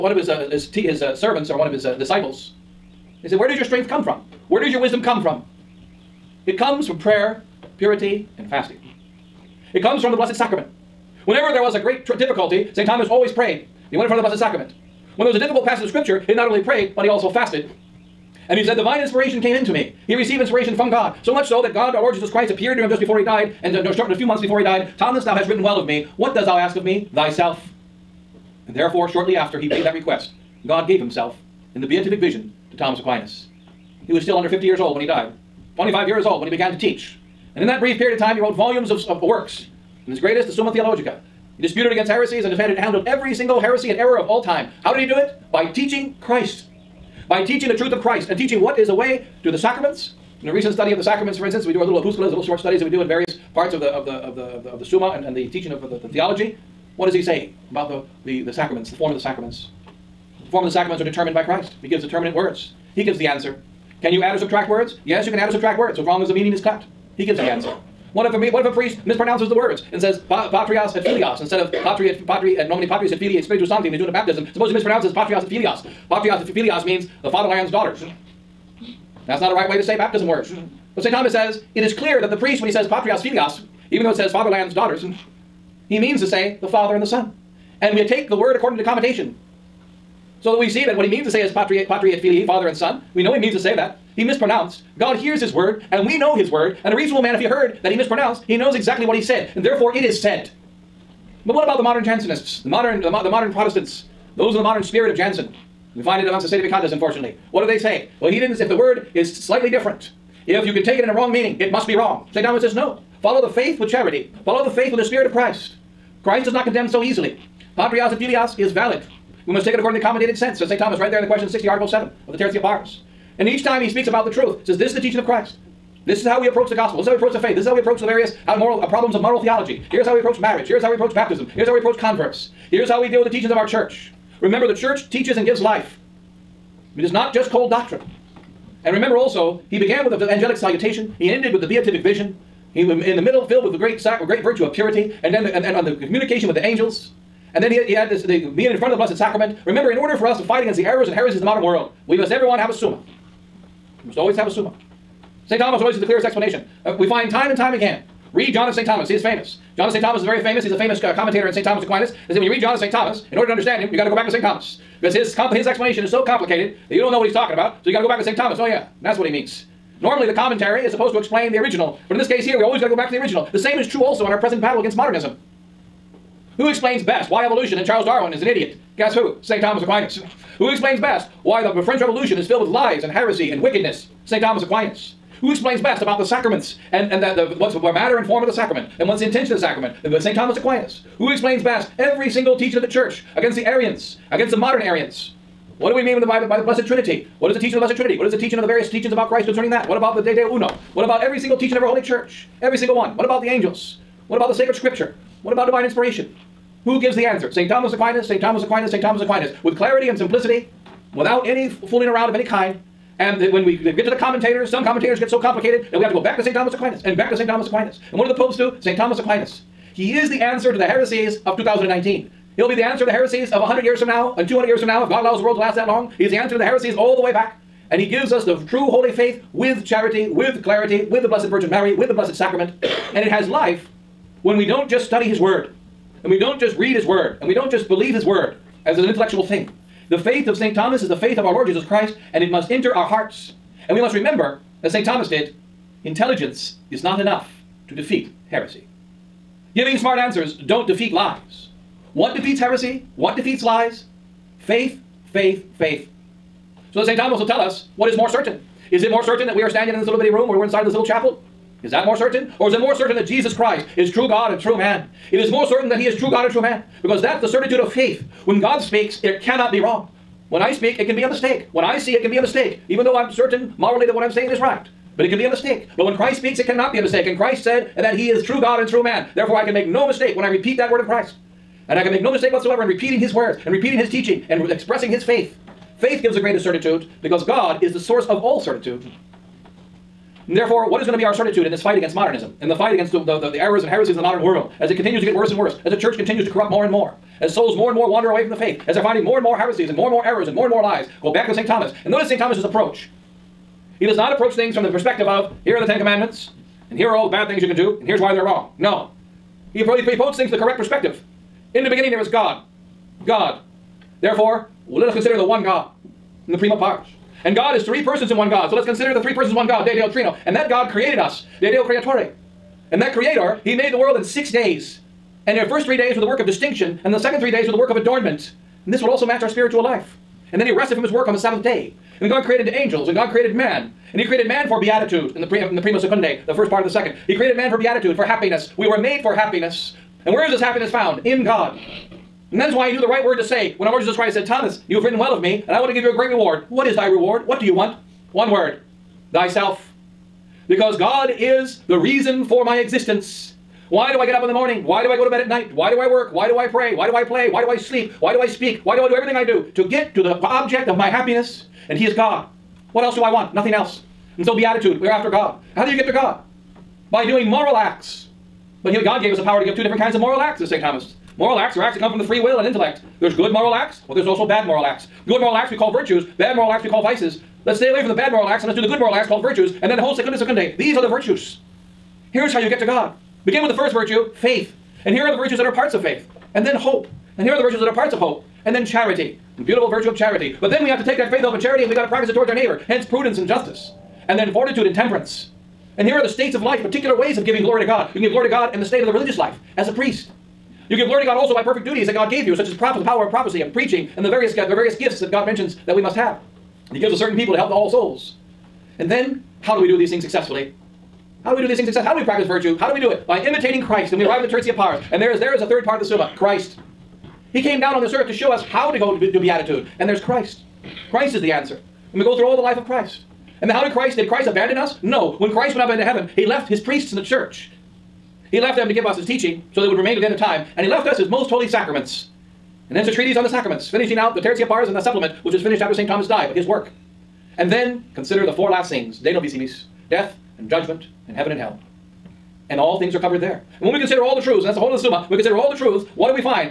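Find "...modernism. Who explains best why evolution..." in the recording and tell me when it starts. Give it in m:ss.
2:54.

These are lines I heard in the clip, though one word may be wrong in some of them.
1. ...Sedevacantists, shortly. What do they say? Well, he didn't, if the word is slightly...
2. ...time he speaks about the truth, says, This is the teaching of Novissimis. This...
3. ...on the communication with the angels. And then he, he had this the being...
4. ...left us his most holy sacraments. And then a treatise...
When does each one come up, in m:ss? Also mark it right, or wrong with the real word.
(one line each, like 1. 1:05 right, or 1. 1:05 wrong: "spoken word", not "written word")
1. 1:46 wrong: "unfortunately", not "shortly"
2. 2:03 wrong: "Christ", not "Novissimis"
3. 2:25 right
4. 7:10 right.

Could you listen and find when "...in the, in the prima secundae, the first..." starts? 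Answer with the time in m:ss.
5:35.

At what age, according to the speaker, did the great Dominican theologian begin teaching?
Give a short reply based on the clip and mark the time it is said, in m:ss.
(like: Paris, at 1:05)
25, at 0:35.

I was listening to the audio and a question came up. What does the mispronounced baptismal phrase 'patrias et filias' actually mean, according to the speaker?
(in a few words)
the fatherland's daughters.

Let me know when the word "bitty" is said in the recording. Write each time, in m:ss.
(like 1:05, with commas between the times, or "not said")
4:20.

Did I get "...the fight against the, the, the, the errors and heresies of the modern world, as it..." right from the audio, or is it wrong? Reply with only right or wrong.
right.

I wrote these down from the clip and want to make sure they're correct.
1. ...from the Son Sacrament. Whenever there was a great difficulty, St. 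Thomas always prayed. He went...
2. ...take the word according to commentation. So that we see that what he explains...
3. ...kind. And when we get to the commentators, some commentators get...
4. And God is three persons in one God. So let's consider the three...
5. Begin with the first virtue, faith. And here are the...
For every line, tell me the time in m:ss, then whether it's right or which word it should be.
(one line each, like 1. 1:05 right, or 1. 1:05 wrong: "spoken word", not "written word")
1. 0:10 wrong: "Blessed", not "Son"
2. 1:28 wrong: "means", not "explains"
3. 3:32 right
4. 5:17 right
5. 6:23 right.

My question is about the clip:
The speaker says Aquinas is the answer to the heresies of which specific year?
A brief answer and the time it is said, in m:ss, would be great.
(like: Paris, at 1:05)
2019, at 3:41.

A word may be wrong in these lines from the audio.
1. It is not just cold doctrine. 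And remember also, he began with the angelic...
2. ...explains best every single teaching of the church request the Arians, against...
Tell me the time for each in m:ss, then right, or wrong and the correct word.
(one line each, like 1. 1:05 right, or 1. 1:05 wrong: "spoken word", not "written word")
1. 2:16 right
2. 3:11 wrong: "against", not "request".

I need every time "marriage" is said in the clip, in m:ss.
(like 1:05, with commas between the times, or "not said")
2:10.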